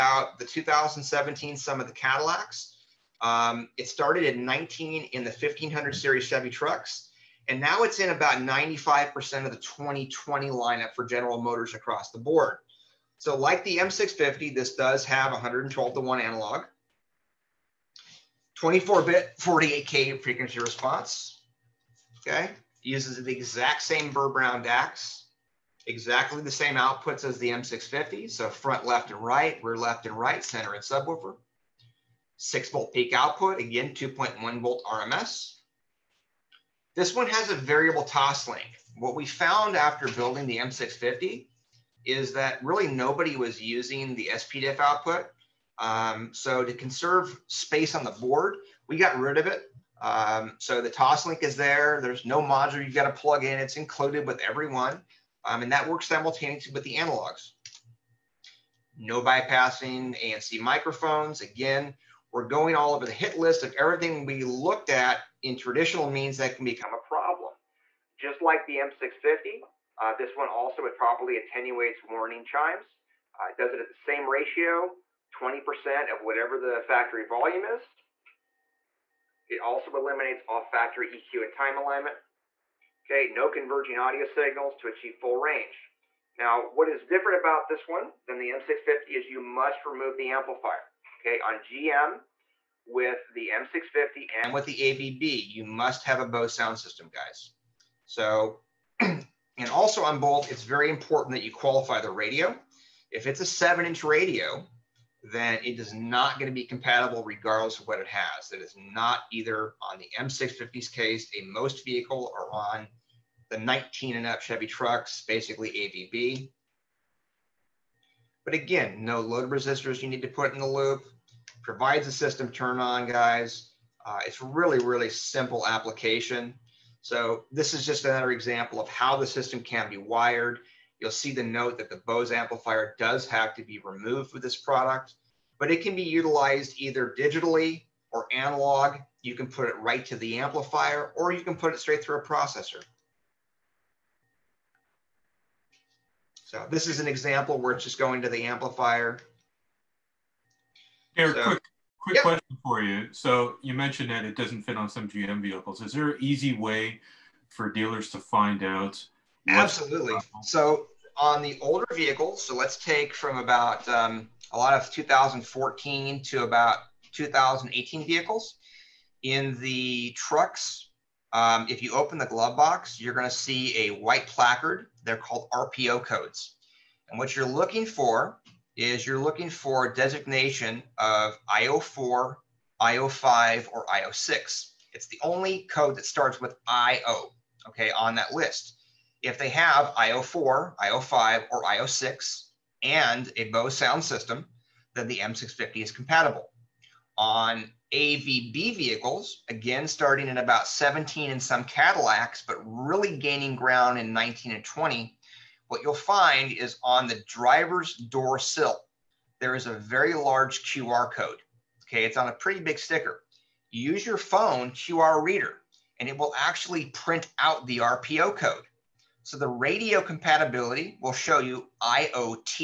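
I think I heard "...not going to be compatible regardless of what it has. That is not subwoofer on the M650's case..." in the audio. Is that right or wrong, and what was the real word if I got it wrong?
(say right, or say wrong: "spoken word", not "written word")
wrong: "either", not "subwoofer".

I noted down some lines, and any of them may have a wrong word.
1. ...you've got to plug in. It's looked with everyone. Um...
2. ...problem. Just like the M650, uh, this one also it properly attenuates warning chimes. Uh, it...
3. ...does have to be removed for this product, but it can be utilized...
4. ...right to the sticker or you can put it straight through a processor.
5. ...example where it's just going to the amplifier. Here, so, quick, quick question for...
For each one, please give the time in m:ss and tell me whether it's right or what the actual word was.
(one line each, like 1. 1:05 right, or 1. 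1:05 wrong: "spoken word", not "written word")
1. 0:52 wrong: "included", not "looked"
2. 1:06 right
3. 2:12 right
4. 2:19 wrong: "amplifier", not "sticker"
5. 2:27 right.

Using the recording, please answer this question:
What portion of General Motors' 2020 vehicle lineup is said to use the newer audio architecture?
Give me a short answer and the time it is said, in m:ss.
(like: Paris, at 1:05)
About 95%, at 0:08.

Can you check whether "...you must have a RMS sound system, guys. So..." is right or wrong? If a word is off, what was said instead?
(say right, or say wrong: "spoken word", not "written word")
wrong: "Bose", not "RMS".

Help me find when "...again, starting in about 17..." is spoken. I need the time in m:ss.
3:19.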